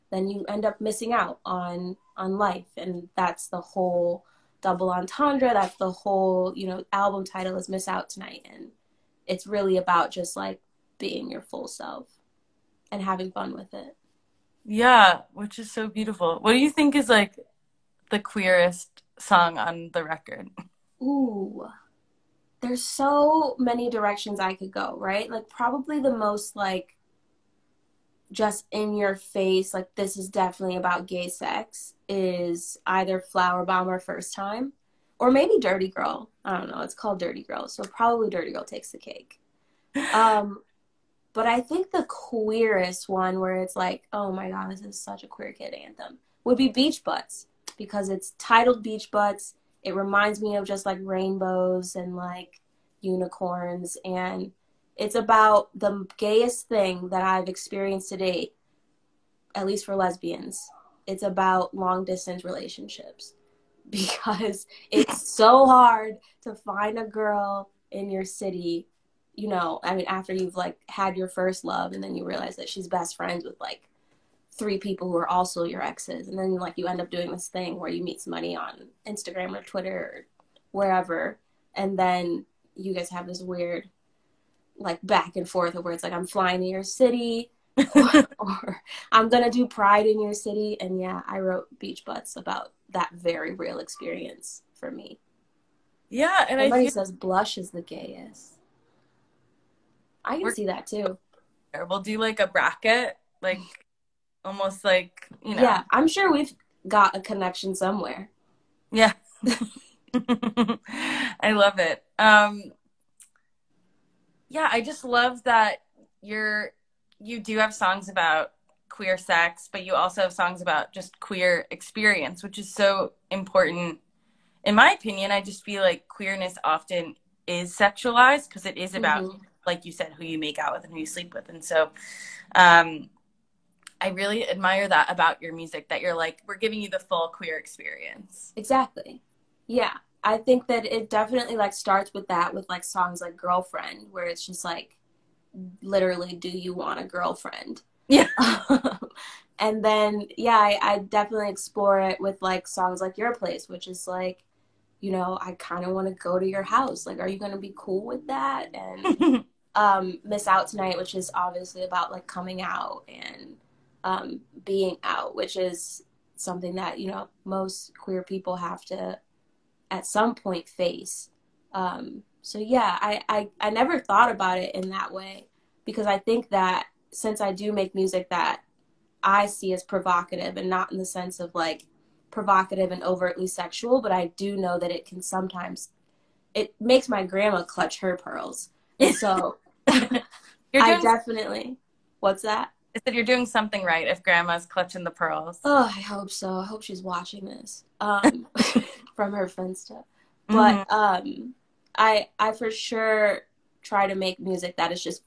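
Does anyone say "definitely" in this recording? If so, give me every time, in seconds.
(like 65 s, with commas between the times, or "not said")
30 s, 141 s, 150 s, 191 s.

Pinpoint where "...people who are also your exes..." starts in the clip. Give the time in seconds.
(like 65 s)
74 s.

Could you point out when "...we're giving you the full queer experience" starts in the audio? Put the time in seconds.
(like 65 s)
136 s.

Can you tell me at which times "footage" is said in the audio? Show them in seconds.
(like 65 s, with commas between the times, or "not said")
not said.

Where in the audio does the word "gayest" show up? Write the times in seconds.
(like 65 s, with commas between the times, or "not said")
56 s, 97 s.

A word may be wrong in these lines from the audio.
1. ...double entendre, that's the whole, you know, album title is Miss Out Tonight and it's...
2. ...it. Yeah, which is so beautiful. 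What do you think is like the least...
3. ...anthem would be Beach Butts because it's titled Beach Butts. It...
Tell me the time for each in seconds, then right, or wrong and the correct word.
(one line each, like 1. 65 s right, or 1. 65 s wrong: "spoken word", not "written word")
1. 4 s right
2. 13 s wrong: "queerest", not "least"
3. 45 s right.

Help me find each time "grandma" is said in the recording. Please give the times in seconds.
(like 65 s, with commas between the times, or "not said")
187 s, 194 s.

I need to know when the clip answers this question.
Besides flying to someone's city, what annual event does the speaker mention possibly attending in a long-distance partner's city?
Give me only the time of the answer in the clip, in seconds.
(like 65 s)
89 s.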